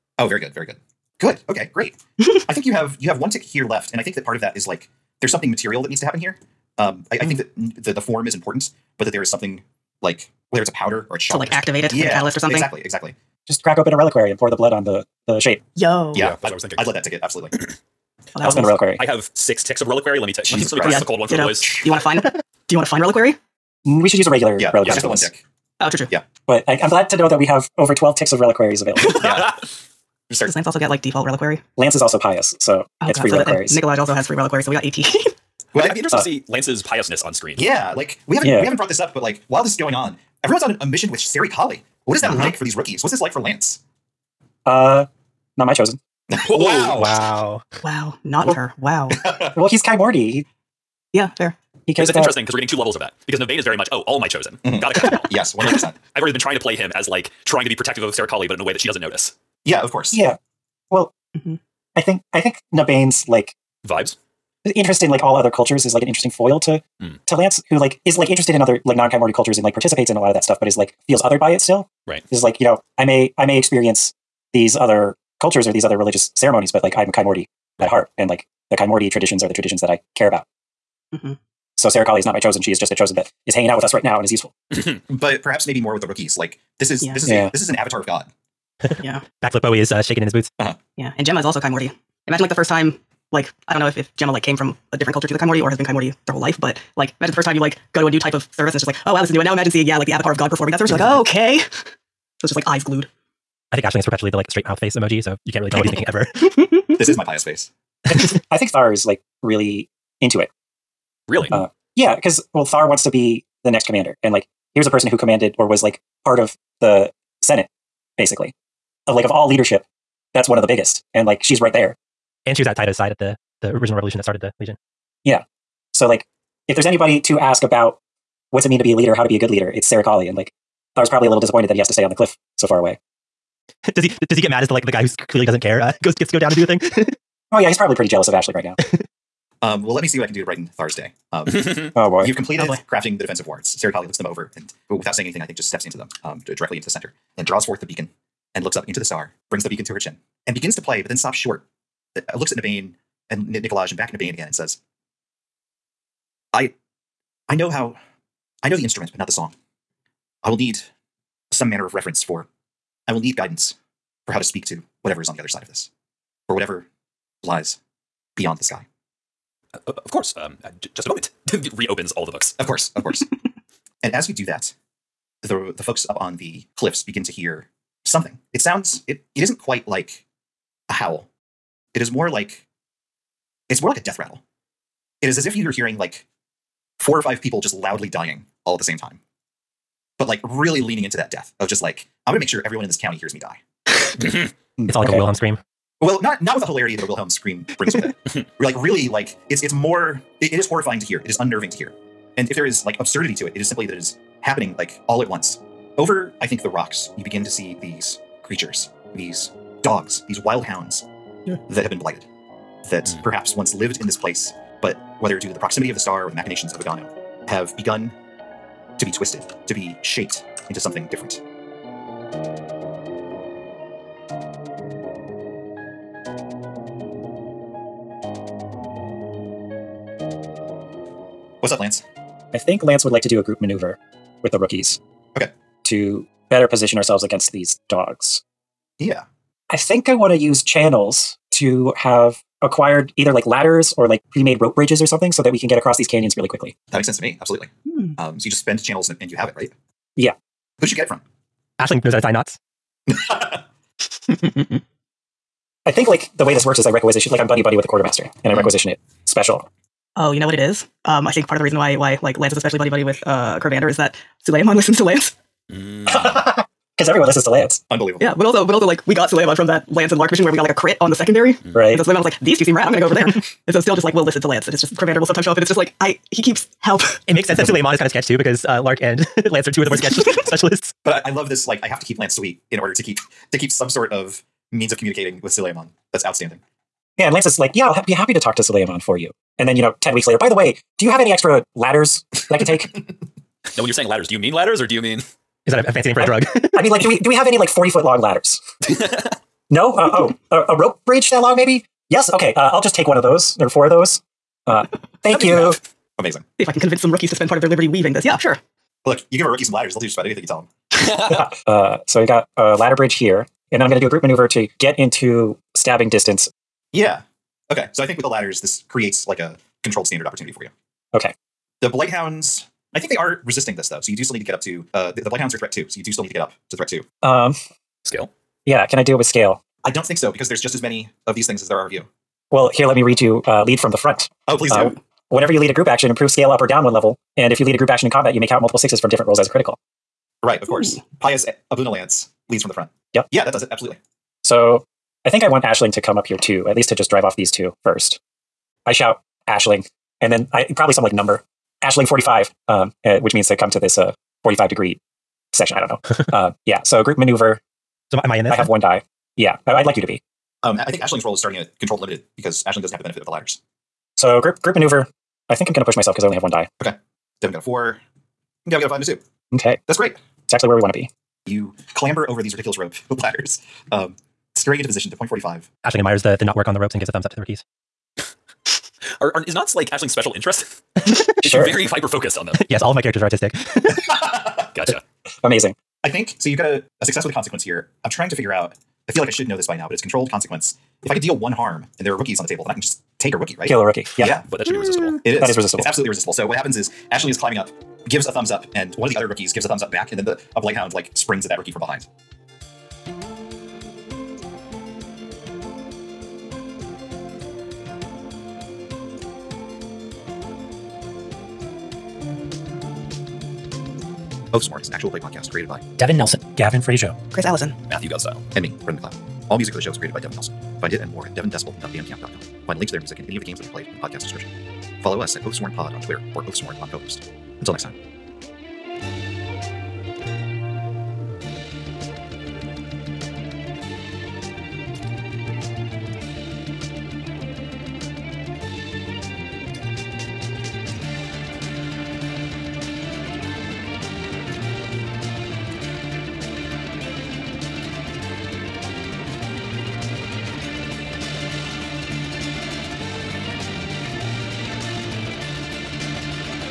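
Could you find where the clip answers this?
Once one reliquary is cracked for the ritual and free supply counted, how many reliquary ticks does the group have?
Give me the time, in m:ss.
0:34.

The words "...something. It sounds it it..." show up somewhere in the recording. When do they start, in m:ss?
2:58.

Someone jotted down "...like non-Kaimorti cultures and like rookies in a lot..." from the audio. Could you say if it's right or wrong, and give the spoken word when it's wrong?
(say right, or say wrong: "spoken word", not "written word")
wrong: "participates", not "rookies".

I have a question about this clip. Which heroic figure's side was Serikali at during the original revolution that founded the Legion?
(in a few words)
Taida.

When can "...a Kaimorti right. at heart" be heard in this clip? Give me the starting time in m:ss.
1:17.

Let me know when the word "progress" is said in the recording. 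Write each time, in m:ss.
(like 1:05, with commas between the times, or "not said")
not said.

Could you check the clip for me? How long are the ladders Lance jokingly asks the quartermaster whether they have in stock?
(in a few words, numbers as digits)
40 feet.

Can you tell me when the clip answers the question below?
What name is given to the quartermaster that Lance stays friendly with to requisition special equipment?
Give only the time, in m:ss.
4:23.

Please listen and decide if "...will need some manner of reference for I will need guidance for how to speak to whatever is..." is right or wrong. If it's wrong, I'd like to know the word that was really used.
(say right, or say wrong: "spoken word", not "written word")
right.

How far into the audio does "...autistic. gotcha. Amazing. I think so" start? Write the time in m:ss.
6:23.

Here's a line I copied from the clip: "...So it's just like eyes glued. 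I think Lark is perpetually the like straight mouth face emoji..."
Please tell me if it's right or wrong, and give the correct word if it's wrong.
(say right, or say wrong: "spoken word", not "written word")
wrong: "Aisling", not "Lark".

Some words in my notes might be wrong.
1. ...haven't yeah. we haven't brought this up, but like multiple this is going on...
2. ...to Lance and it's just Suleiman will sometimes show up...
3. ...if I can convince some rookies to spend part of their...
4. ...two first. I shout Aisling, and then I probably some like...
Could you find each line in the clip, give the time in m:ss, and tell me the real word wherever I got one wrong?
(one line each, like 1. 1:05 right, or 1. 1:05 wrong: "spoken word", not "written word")
1. 0:38 wrong: "while", not "multiple"
2. 4:34 wrong: "Cravander", not "Suleiman"
3. 5:06 right
4. 5:47 right.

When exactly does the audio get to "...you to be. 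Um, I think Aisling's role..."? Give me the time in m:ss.
5:59.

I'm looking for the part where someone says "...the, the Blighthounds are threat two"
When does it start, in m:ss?
5:25.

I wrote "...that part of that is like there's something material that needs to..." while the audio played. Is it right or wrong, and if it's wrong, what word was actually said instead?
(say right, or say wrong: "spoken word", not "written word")
right.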